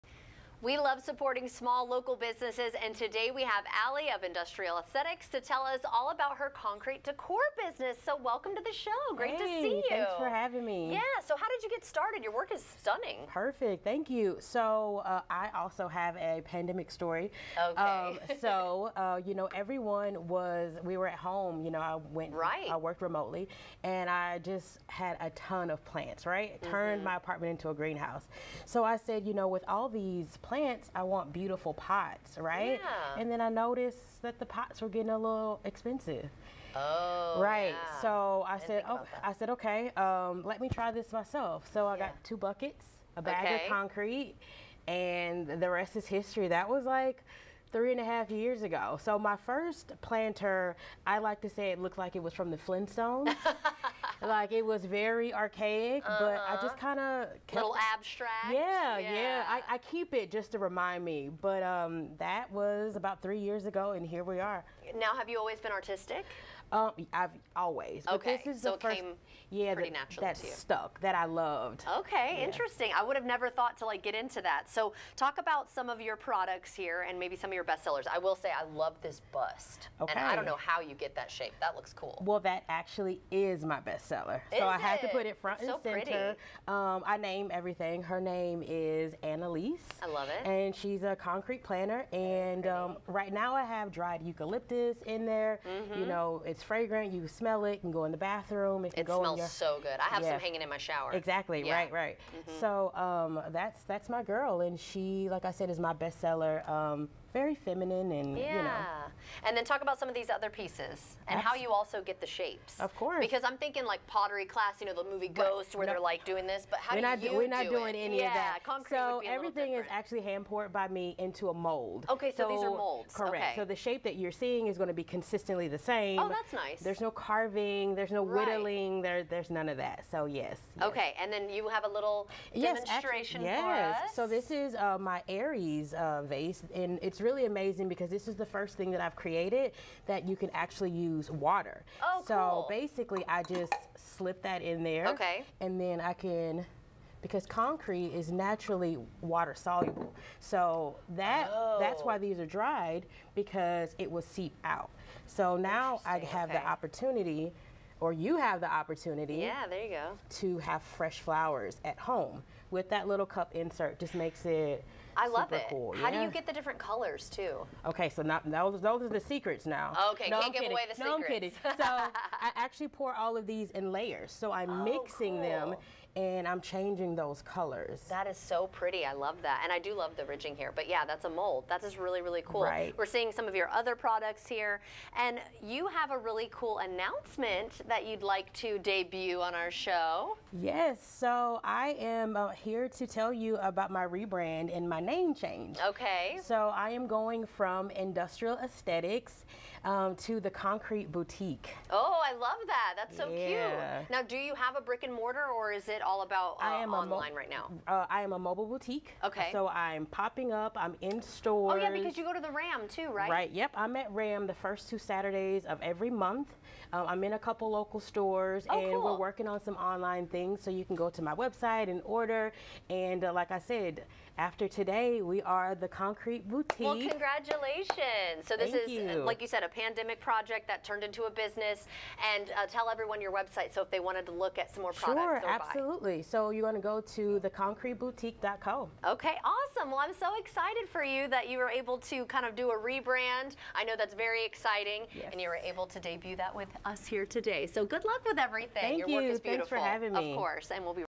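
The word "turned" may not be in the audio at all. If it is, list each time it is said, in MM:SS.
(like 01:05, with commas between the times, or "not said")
00:26, 03:50.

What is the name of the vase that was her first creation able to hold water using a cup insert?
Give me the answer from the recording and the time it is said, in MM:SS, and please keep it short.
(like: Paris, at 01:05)
Aries, at 02:15.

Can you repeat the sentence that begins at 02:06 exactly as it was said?
There's no carving, there's no right.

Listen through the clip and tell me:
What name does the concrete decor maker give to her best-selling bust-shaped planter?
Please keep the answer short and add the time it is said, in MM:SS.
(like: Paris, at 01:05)
Annalise, at 01:29.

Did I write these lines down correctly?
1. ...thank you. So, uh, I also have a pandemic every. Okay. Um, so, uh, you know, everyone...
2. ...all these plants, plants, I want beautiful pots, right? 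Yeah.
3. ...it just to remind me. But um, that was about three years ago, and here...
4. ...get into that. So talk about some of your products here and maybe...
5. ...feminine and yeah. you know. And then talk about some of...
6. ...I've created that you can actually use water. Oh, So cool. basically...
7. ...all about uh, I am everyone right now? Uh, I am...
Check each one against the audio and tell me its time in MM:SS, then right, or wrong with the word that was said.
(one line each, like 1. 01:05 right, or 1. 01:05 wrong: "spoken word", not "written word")
1. 00:13 wrong: "story", not "every"
2. 00:29 right
3. 01:00 right
4. 01:14 right
5. 01:47 right
6. 02:19 right
7. 03:26 wrong: "online", not "everyone".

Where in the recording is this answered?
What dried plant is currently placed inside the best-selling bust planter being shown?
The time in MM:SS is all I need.
01:33.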